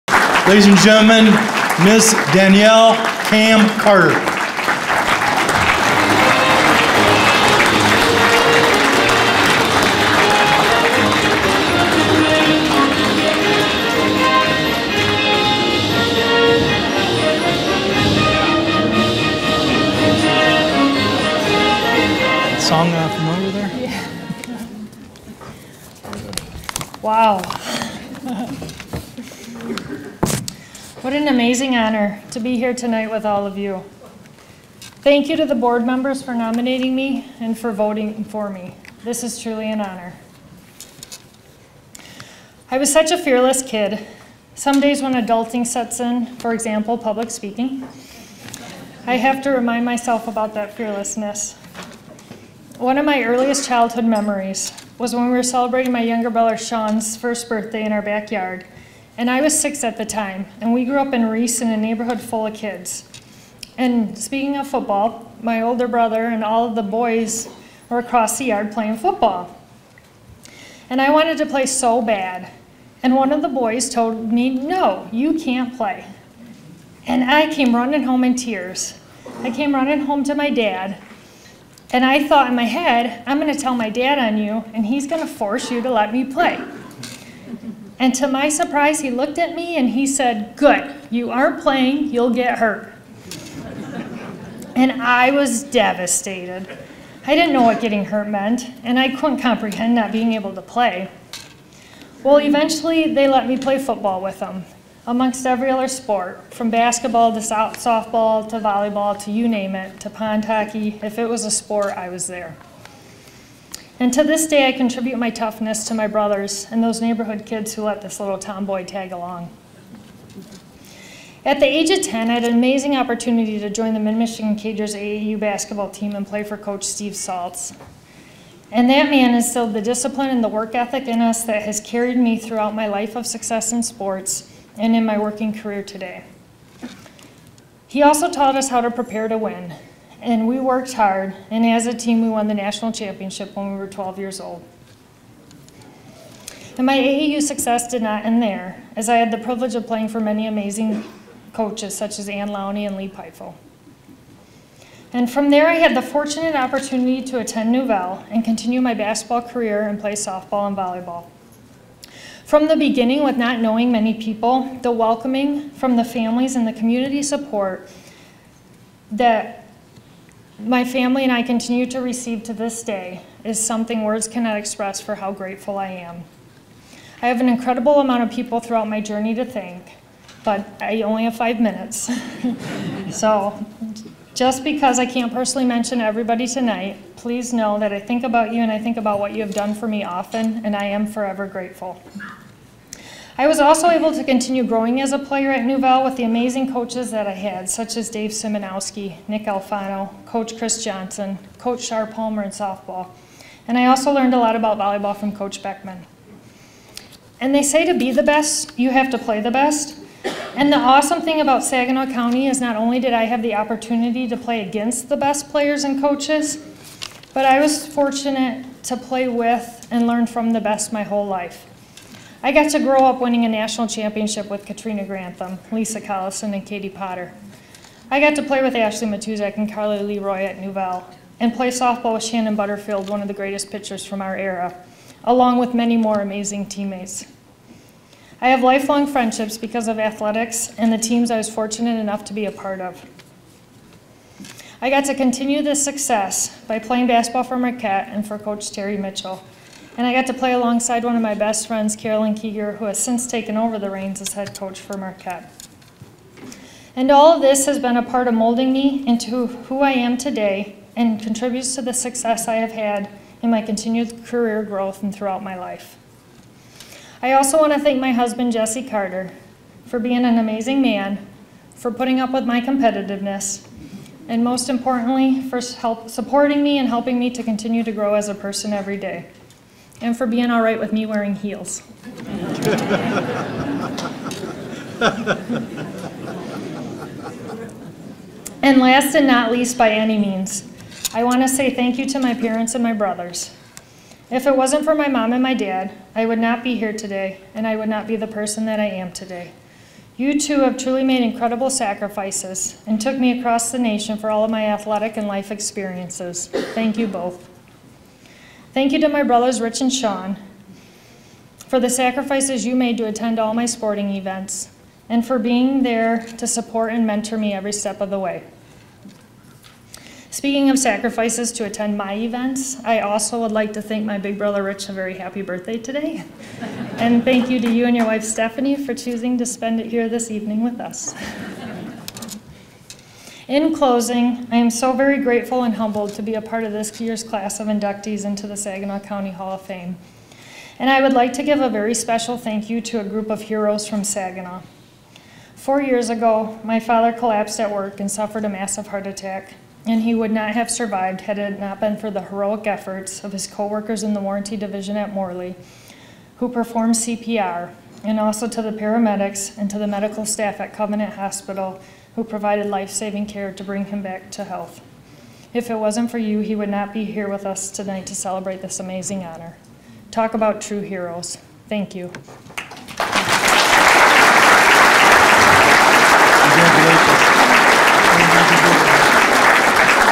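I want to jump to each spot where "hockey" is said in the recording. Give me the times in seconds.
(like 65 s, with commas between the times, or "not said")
110 s.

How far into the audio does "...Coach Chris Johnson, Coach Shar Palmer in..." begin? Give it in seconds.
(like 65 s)
200 s.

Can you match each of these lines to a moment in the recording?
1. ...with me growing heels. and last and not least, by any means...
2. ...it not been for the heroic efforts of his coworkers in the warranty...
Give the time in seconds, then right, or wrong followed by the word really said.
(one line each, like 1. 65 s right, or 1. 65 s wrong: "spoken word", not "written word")
1. 280 s wrong: "wearing", not "growing"
2. 351 s right.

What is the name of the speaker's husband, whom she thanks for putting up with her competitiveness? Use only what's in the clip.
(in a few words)
Jesse Carter.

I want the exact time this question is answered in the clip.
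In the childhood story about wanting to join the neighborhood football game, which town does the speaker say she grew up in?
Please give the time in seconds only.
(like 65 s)
61 s.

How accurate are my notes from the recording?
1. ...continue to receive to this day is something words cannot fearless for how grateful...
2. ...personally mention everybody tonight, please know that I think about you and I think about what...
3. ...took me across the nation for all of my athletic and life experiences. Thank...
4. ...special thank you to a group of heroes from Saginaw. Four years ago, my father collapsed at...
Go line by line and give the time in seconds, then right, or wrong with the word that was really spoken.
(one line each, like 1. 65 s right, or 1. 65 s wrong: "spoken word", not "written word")
1. 171 s wrong: "express", not "fearless"
2. 185 s right
3. 303 s right
4. 341 s right.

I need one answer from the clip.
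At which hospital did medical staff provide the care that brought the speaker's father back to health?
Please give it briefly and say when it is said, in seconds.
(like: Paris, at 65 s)
Covenant Hospital, at 360 s.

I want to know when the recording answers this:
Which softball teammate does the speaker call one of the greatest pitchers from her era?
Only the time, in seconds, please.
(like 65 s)
232 s.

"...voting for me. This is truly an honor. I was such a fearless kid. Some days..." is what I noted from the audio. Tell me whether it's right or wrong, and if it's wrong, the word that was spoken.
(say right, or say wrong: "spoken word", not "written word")
right.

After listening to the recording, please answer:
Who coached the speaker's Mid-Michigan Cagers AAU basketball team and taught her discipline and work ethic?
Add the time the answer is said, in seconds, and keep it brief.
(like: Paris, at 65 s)
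Steve Saltz, at 126 s.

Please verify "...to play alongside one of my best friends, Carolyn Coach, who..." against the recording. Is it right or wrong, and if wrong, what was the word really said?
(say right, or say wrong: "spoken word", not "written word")
wrong: "Keeger", not "Coach".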